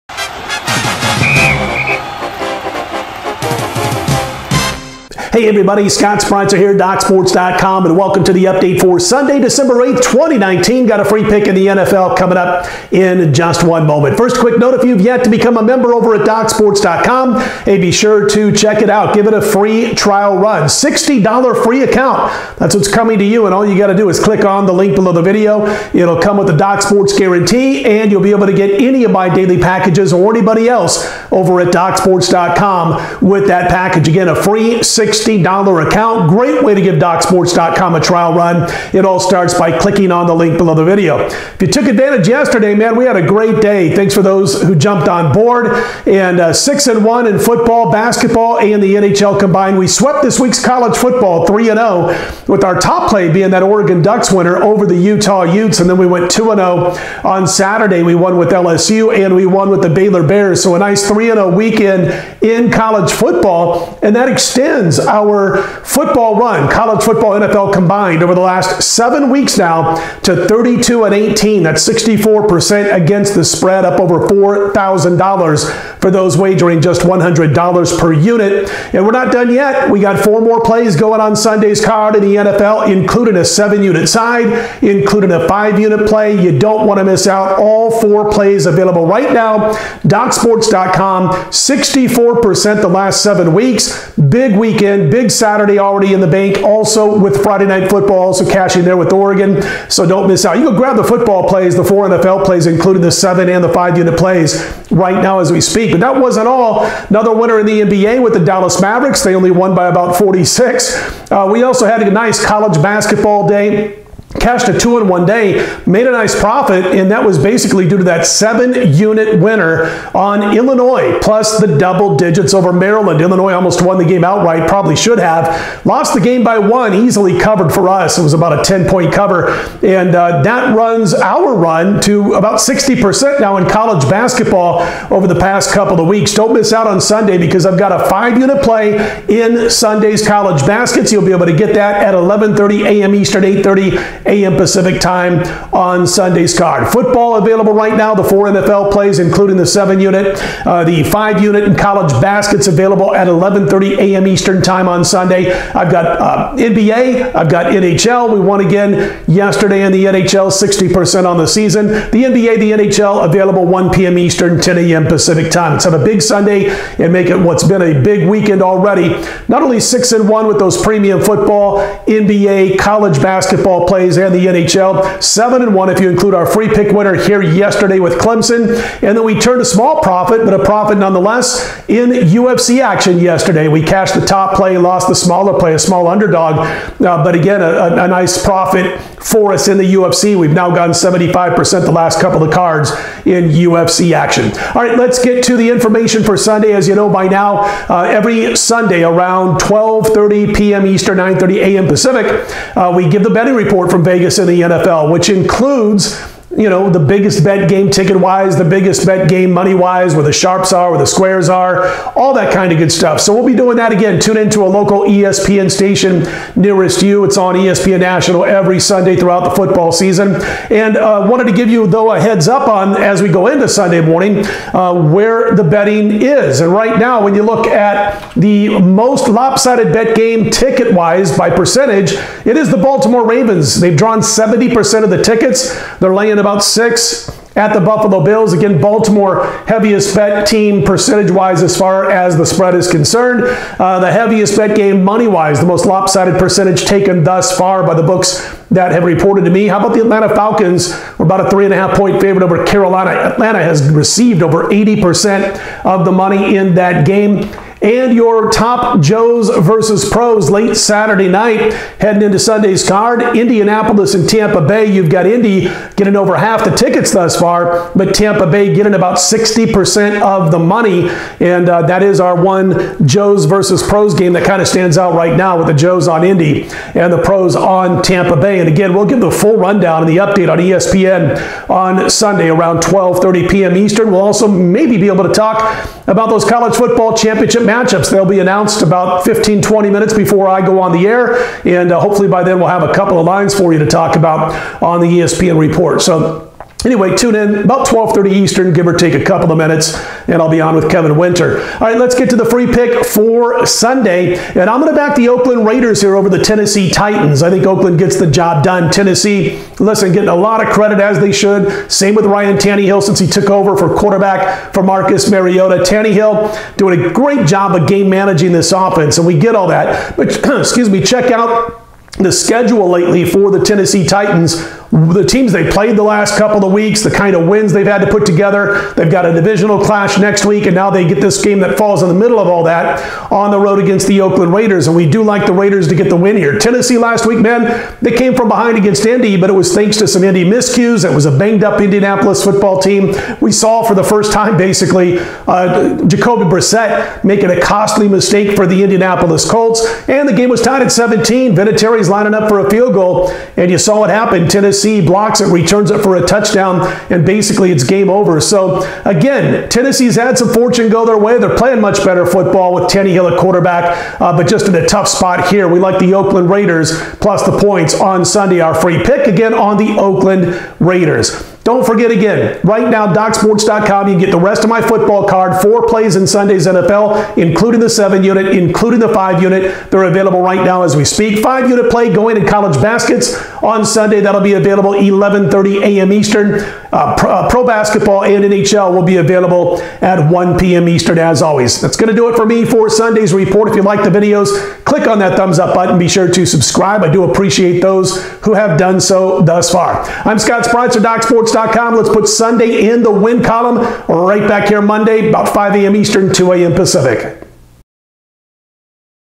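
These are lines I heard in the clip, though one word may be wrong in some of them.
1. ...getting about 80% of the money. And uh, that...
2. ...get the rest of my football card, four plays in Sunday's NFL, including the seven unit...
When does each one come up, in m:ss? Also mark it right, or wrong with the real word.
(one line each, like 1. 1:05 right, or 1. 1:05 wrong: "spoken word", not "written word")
1. 4:28 wrong: "60", not "80"
2. 6:14 right.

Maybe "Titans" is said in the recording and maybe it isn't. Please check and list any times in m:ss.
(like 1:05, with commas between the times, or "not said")
5:06, 5:24.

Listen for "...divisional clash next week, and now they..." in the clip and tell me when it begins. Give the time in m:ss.
5:29.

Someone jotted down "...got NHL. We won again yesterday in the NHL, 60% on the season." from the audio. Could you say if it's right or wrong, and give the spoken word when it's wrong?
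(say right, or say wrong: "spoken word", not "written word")
right.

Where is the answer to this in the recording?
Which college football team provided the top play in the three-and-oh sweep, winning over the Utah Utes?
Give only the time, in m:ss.
0:53.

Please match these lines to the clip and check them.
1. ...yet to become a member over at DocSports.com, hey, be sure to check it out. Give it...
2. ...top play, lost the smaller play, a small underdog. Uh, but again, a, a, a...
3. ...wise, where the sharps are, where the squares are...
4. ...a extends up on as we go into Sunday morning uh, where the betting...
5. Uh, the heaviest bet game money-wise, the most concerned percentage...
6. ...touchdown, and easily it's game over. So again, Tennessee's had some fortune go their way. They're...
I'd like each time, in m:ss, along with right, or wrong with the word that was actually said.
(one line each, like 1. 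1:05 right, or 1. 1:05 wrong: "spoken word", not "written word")
1. 0:14 right
2. 3:04 right
3. 3:29 right
4. 3:42 wrong: "heads", not "extends"
5. 4:03 wrong: "lopsided", not "concerned"
6. 5:56 wrong: "basically", not "easily".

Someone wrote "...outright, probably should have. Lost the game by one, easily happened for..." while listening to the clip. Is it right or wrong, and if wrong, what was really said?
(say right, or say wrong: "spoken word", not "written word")
wrong: "covered", not "happened".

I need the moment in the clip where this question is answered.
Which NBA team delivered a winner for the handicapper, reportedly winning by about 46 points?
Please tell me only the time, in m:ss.
1:48.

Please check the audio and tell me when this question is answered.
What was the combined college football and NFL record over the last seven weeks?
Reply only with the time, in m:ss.
1:10.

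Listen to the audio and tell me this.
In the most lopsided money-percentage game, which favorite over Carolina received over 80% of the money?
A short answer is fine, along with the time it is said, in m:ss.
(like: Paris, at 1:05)
Atlanta Falcons, at 4:10.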